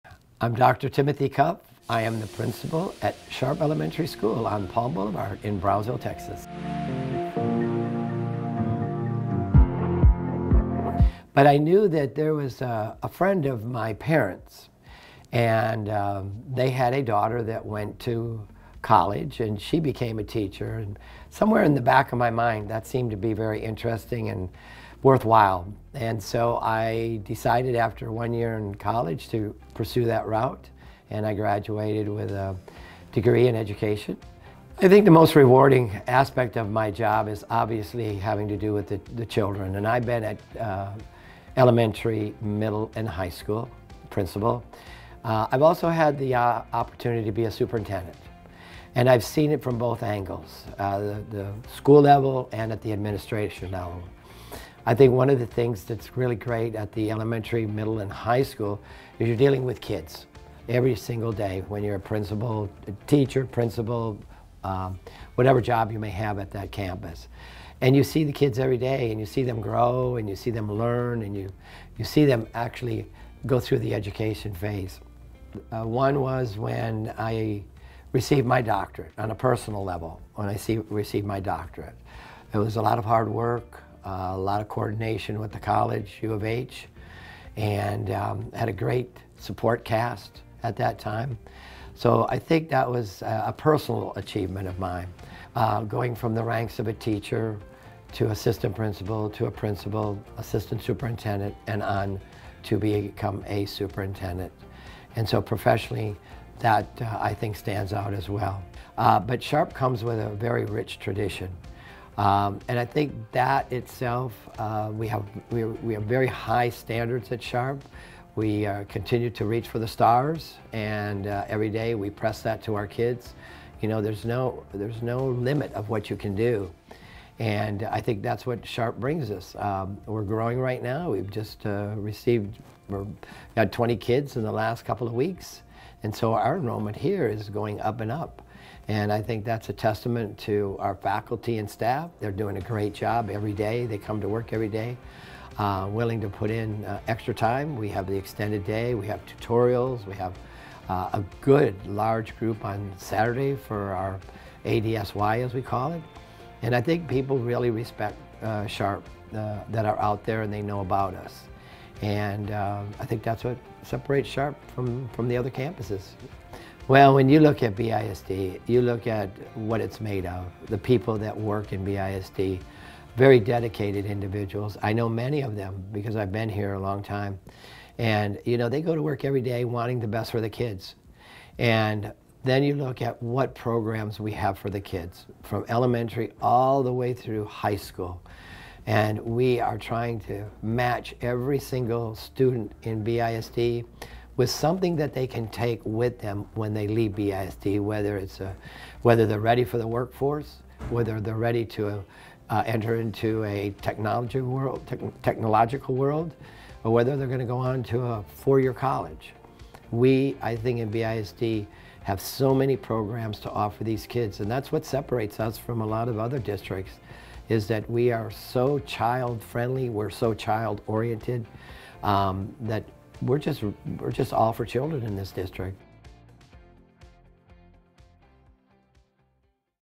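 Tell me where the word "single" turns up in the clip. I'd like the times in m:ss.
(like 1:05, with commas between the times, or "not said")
1:00, 3:11.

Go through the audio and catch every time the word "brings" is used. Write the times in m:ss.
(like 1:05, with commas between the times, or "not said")
2:08.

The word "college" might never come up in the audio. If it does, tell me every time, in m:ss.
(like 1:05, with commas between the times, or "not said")
0:18, 0:28, 1:25, 3:28.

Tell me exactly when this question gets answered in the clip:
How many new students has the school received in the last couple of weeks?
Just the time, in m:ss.
2:13.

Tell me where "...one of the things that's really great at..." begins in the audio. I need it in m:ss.
0:55.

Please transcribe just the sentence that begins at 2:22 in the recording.
They're doing a great job every day.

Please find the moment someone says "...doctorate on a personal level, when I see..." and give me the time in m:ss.
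1:18.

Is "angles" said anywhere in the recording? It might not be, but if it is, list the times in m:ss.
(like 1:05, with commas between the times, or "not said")
0:50.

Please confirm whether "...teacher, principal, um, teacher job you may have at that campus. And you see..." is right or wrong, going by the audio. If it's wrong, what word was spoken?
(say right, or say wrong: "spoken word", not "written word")
wrong: "whatever", not "teacher".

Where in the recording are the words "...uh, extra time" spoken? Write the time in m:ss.
2:26.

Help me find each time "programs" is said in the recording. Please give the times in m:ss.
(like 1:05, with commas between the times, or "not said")
3:03, 3:32.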